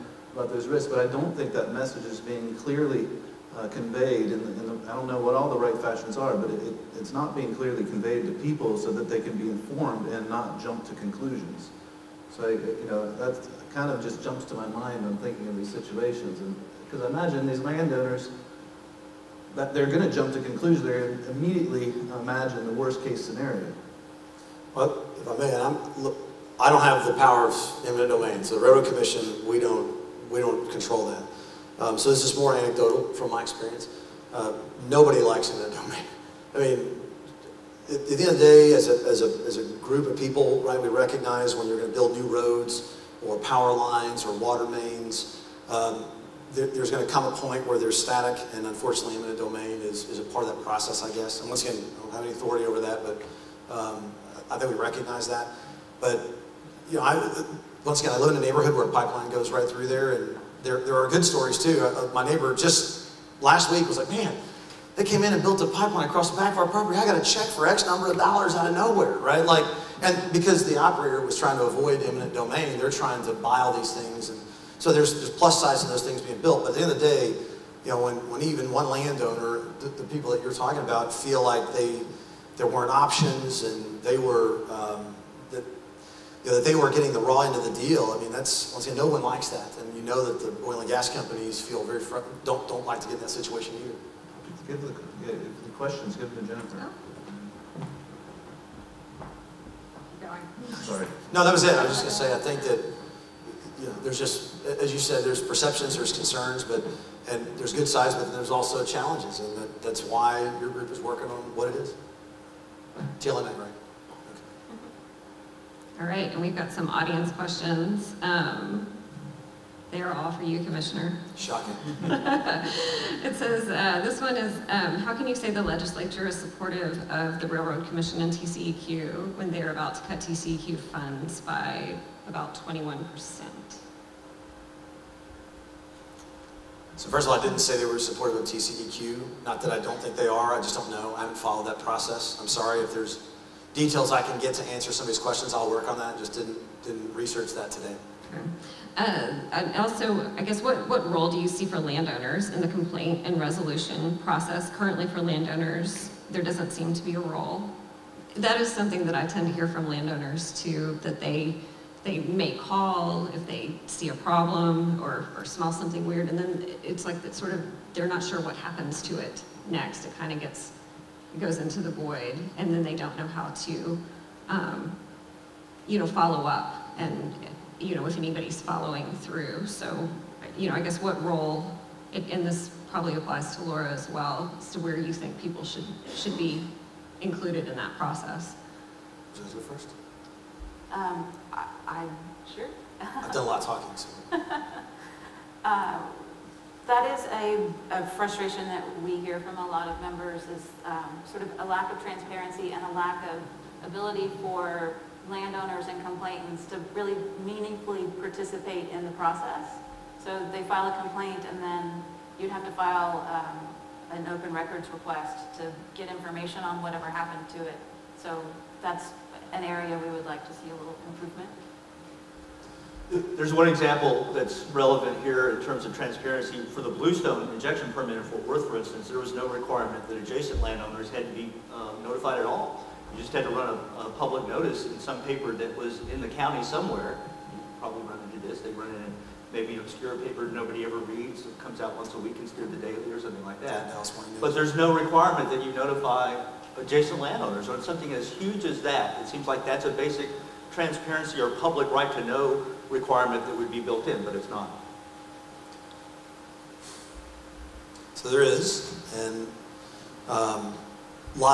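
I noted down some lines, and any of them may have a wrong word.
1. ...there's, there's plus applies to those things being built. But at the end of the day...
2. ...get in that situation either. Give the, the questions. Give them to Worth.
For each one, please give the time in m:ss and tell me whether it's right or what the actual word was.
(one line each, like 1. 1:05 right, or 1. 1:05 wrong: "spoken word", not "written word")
1. 1:14 wrong: "sides", not "applies"
2. 1:33 wrong: "Jennifer", not "Worth".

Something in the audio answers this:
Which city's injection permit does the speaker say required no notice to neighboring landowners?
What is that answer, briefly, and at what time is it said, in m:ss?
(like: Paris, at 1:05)
Fort Worth, at 3:48.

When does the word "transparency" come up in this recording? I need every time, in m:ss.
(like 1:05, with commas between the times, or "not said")
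3:22, 3:45, 4:10.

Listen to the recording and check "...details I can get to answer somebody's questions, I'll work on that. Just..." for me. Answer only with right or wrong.
right.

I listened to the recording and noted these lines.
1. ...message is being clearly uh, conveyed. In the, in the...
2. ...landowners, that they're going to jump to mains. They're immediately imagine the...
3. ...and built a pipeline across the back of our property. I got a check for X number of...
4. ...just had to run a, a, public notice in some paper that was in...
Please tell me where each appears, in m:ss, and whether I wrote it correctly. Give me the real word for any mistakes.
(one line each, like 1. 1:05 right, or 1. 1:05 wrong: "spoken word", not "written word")
1. 0:01 right
2. 0:17 wrong: "conclusions", not "mains"
3. 1:05 right
4. 3:53 right.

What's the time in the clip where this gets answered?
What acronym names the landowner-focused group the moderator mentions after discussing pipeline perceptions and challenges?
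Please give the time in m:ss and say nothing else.
1:53.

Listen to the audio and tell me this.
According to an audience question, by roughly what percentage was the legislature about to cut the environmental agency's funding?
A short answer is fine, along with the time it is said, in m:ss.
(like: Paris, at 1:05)
21%, at 2:12.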